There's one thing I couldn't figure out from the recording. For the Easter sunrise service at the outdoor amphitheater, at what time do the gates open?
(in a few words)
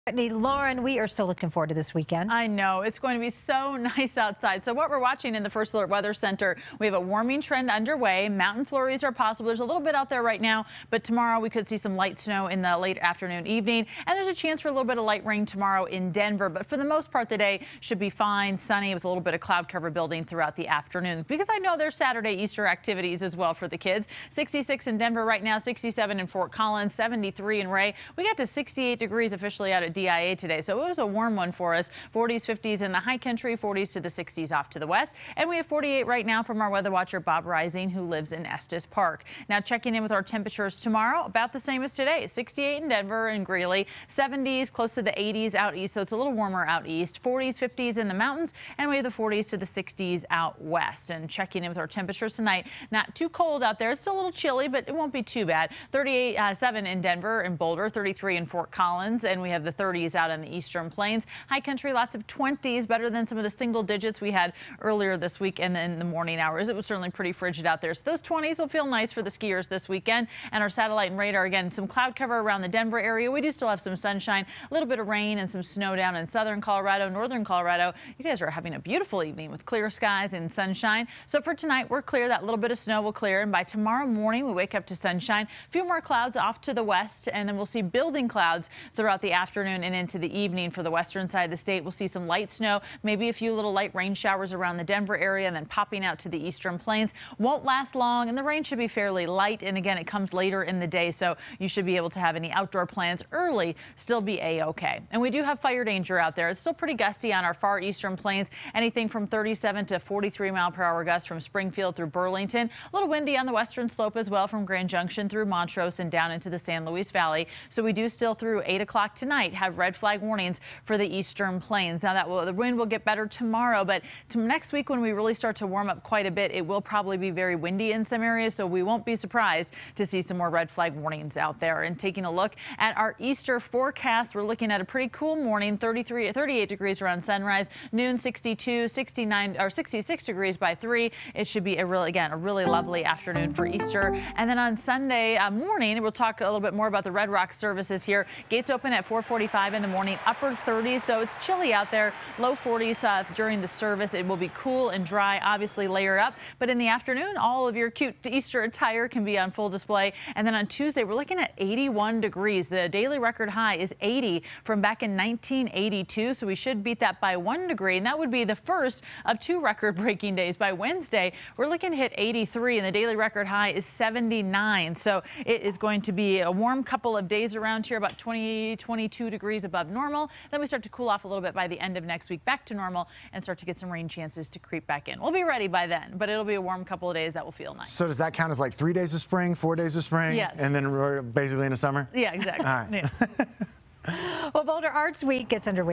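4:45.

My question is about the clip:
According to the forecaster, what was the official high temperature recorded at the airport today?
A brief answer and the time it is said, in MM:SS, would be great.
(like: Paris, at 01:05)
68 degrees, at 00:28.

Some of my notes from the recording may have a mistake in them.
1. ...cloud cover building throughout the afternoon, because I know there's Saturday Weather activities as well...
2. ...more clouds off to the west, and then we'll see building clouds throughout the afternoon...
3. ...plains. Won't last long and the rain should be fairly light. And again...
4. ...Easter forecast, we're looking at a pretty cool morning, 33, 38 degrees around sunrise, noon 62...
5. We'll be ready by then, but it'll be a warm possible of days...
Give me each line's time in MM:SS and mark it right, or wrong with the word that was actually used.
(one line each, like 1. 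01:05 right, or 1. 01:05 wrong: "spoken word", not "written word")
1. 00:19 wrong: "Easter", not "Weather"
2. 01:25 right
3. 01:36 right
4. 02:13 right
5. 03:05 wrong: "couple", not "possible".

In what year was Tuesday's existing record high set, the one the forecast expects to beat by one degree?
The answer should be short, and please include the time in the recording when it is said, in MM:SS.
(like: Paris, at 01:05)
1982, at 02:45.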